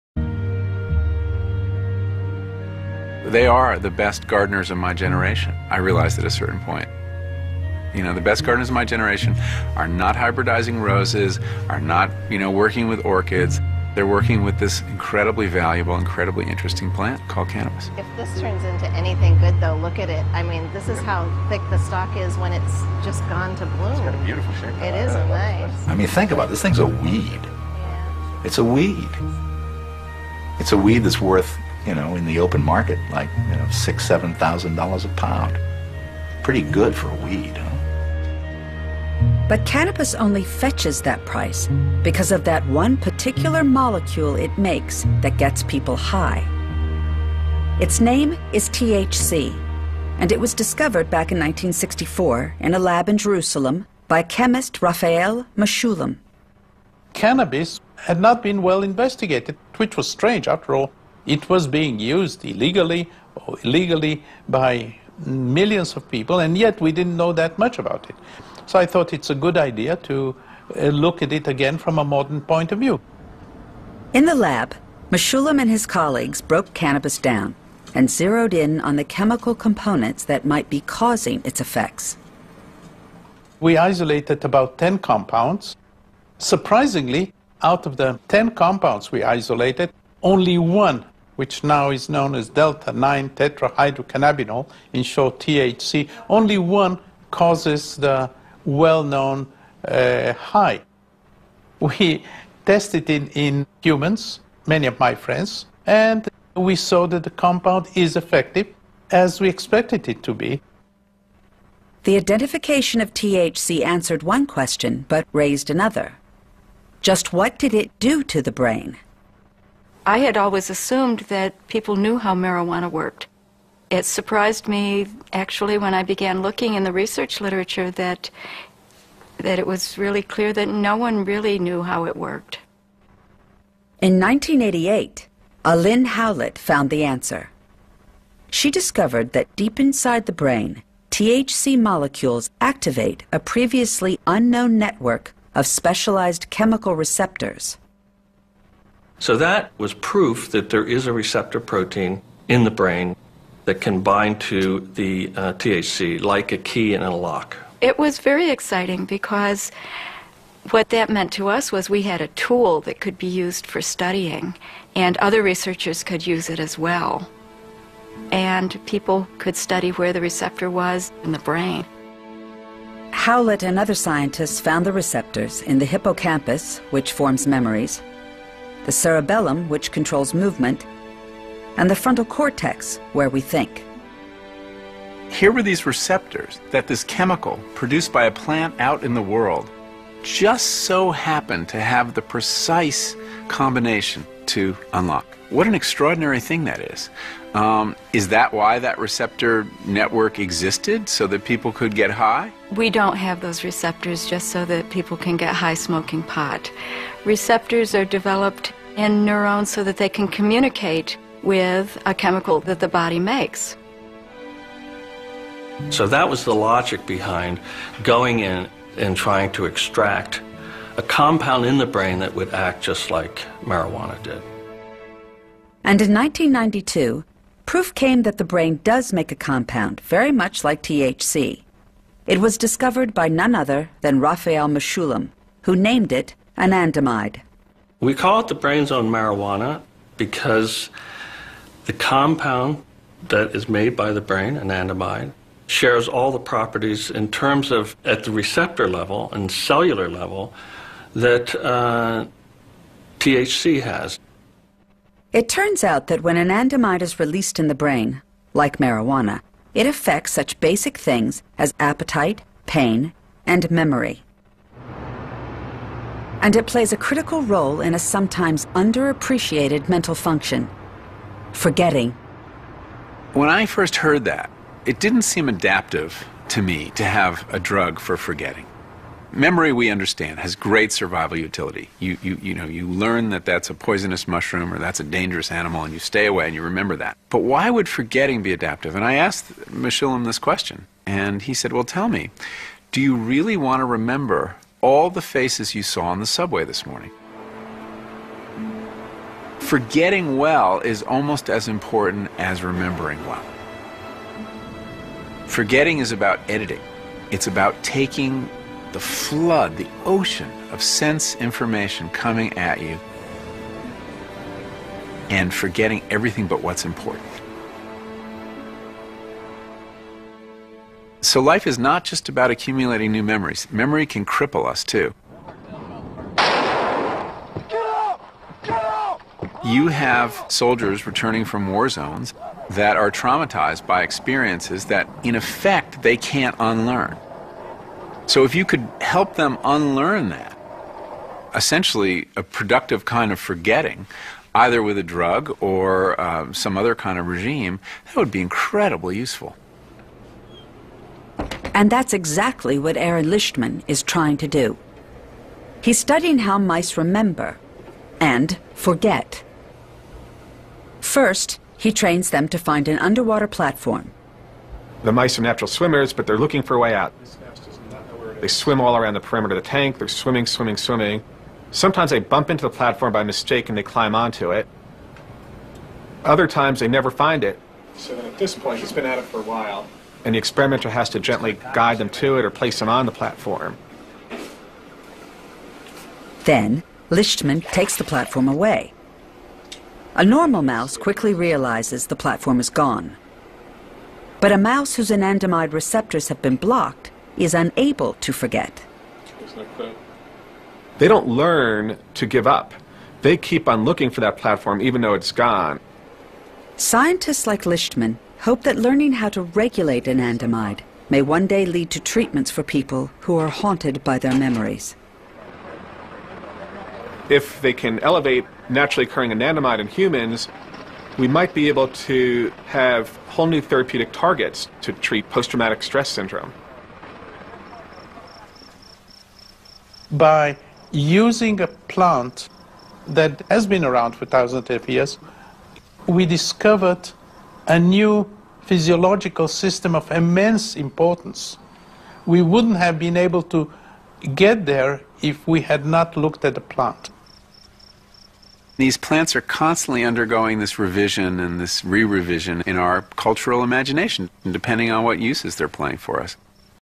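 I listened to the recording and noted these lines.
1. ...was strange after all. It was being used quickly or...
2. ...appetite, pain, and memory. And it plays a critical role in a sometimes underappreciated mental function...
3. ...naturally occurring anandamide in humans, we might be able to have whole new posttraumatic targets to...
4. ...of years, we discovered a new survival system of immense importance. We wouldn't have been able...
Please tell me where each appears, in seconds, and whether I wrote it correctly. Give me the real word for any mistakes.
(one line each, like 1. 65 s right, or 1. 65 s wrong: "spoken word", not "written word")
1. 59 s wrong: "illegally", not "quickly"
2. 261 s right
3. 418 s wrong: "therapeutic", not "posttraumatic"
4. 434 s wrong: "physiological", not "survival".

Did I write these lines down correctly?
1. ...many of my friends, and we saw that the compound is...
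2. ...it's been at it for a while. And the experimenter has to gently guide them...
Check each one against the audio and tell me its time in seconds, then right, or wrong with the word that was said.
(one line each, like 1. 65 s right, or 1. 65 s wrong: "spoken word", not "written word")
1. 104 s right
2. 378 s right.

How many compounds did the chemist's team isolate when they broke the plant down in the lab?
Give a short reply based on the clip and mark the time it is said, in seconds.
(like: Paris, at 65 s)
10, at 84 s.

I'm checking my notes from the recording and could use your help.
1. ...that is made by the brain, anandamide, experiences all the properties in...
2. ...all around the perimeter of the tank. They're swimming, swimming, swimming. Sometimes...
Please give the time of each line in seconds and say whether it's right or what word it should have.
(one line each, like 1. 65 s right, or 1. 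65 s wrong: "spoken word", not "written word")
1. 243 s wrong: "shares", not "experiences"
2. 368 s right.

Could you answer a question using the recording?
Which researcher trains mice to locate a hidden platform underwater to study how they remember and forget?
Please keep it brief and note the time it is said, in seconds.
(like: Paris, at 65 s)
Aron Lichtman, at 352 s.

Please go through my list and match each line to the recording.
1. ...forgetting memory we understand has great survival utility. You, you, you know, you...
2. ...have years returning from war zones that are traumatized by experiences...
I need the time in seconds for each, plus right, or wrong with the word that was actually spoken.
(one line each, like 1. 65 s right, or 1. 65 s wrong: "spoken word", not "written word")
1. 278 s right
2. 329 s wrong: "soldiers", not "years".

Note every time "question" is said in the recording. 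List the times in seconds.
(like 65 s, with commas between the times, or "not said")
114 s, 290 s.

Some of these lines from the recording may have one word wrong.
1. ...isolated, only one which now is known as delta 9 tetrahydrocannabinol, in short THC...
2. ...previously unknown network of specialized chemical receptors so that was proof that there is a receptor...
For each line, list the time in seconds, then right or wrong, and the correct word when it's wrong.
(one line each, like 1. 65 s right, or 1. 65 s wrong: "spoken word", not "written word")
1. 89 s right
2. 143 s right.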